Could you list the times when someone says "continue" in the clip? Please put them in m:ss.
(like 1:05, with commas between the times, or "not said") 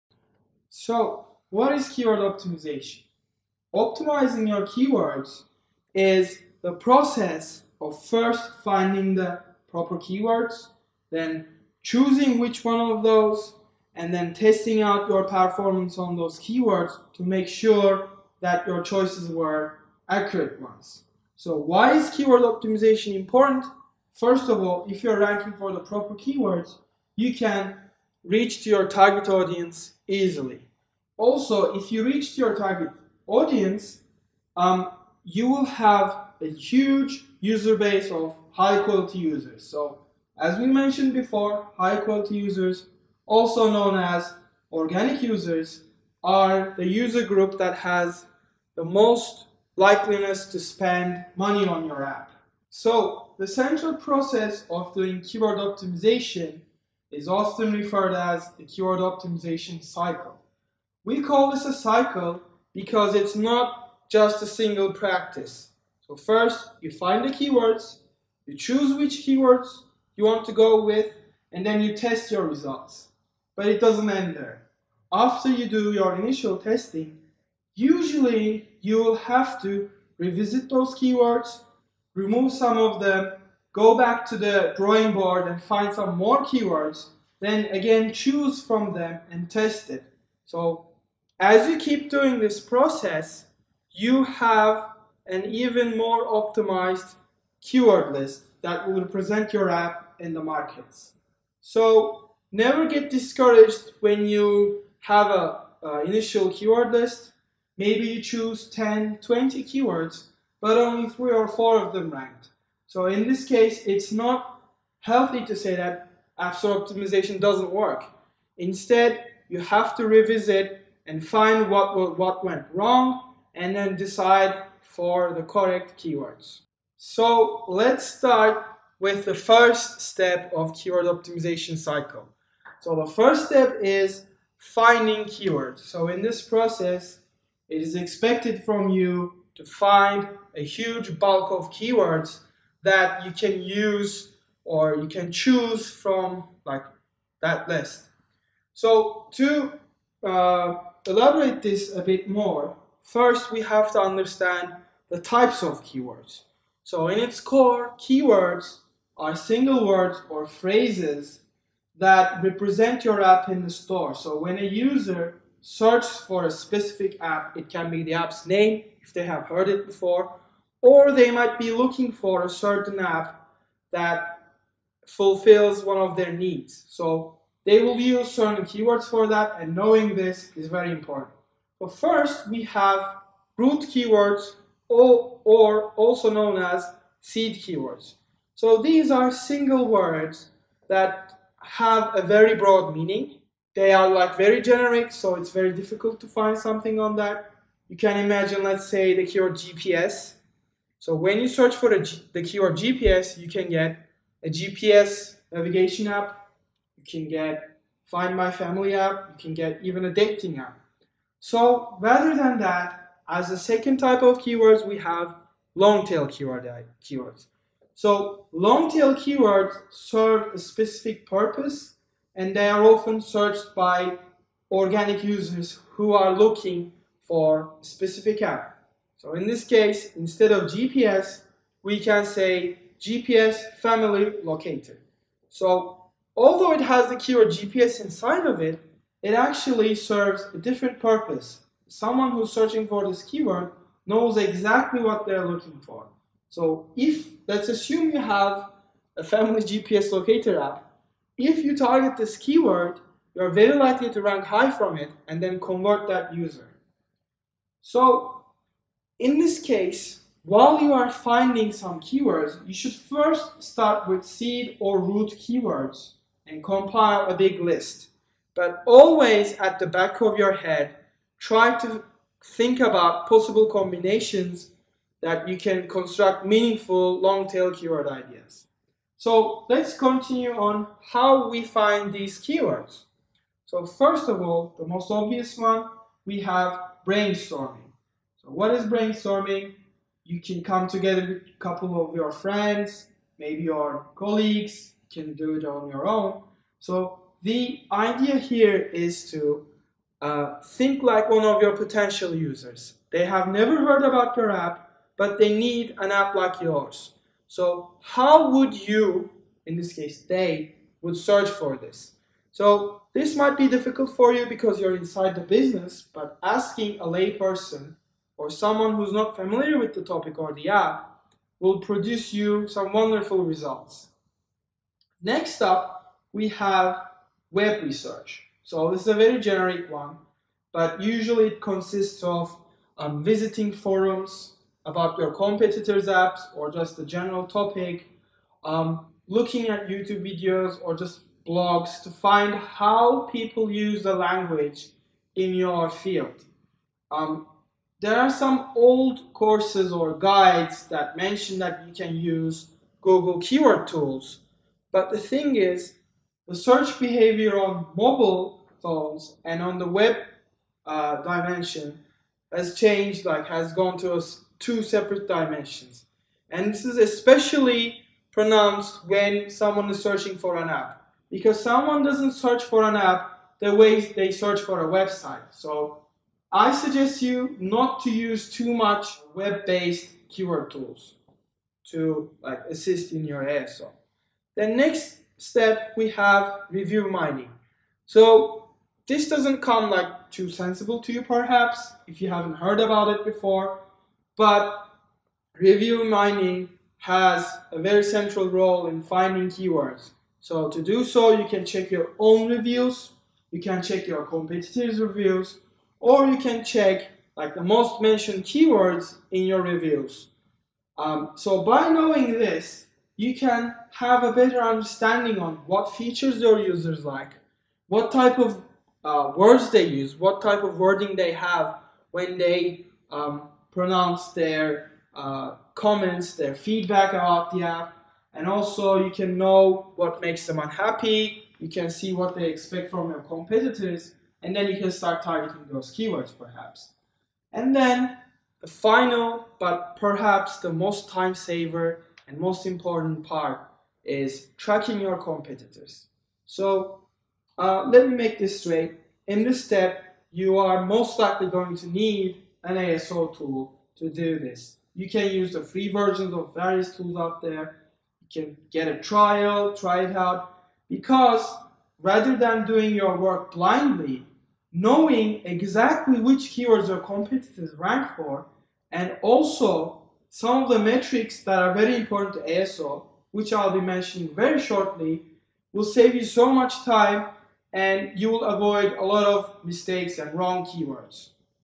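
4:39.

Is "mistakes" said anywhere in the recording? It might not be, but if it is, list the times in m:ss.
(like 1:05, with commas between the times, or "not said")
7:59.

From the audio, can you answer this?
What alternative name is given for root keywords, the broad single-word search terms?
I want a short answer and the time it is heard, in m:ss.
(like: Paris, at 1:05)
seed keywords, at 3:07.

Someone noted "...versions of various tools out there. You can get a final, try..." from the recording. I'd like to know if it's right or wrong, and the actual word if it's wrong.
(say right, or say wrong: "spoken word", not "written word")
wrong: "trial", not "final".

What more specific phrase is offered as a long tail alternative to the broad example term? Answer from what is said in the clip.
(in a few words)
GPS family locator.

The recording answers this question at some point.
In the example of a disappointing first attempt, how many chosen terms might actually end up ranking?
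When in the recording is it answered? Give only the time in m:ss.
1:51.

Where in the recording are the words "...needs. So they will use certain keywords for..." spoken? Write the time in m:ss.
2:56.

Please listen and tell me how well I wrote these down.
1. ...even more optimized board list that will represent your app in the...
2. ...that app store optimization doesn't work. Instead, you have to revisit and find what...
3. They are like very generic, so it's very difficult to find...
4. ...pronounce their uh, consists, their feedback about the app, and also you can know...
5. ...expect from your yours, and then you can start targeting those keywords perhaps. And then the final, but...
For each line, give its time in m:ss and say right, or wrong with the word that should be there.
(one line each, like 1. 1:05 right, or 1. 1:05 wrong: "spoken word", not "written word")
1. 1:35 wrong: "keyword", not "board"
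2. 1:55 right
3. 3:13 right
4. 7:03 wrong: "comments", not "consists"
5. 7:12 wrong: "competitors", not "yours".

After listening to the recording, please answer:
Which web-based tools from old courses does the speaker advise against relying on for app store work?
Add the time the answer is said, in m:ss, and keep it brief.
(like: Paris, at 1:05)
Google Keyword Tools, at 5:53.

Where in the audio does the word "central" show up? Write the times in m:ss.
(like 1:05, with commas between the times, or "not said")
0:53, 6:38.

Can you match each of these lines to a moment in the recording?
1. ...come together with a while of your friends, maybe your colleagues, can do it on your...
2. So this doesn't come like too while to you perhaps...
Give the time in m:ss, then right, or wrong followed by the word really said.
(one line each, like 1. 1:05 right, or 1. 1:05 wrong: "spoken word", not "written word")
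1. 4:50 wrong: "couple", not "while"
2. 6:28 wrong: "sensible", not "while".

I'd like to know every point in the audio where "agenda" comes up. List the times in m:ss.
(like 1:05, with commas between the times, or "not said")
not said.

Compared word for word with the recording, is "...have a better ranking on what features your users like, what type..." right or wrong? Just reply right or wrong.
wrong.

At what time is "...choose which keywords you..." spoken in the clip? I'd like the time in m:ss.
1:08.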